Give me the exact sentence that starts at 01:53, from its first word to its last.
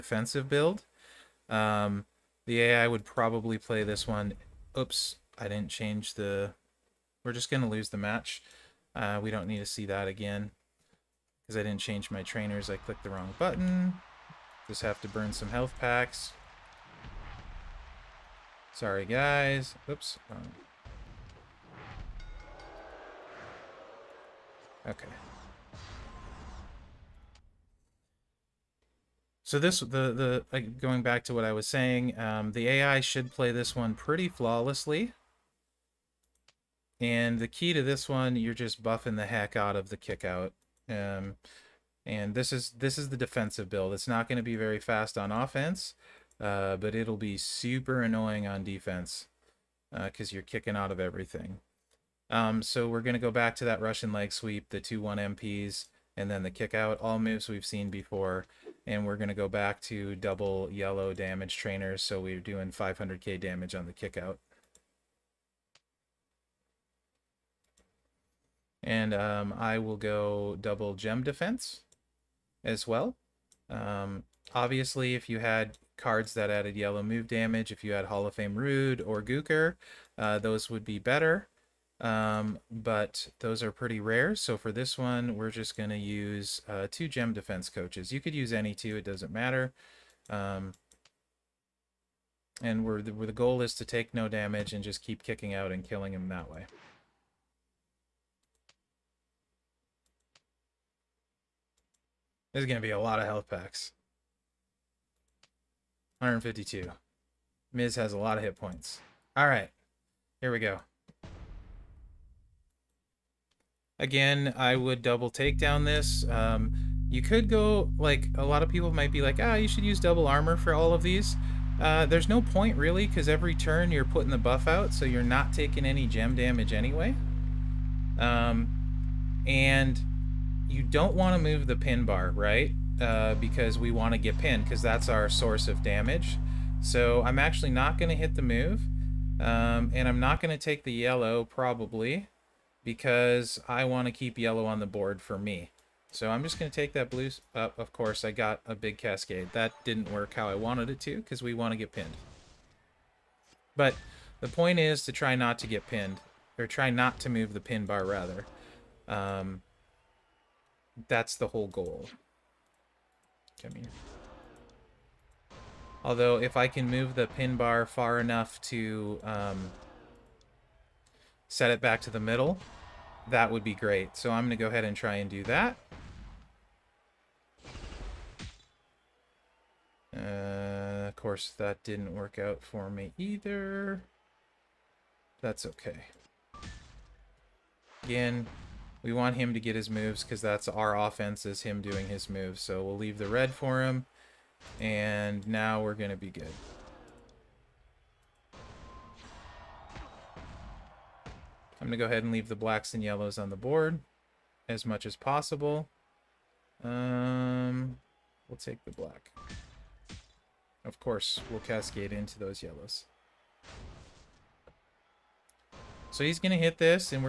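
Again, I would double take down this.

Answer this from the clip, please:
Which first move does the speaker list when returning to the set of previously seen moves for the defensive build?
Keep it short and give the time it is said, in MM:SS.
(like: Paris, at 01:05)
Russian leg sweep, at 00:53.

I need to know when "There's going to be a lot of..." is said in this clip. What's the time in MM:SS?
01:42.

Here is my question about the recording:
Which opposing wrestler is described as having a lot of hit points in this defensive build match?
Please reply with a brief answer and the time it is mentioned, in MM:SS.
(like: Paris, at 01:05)
Miz, at 01:47.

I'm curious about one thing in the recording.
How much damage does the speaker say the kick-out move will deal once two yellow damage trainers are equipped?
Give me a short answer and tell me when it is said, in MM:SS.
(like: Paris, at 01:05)
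500k, at 01:02.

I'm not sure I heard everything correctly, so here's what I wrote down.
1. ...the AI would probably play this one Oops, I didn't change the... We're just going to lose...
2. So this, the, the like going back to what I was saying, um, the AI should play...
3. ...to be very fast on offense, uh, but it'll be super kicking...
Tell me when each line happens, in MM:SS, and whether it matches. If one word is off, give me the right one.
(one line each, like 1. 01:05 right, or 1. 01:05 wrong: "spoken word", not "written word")
1. 00:02 right
2. 00:29 right
3. 00:44 wrong: "annoying", not "kicking".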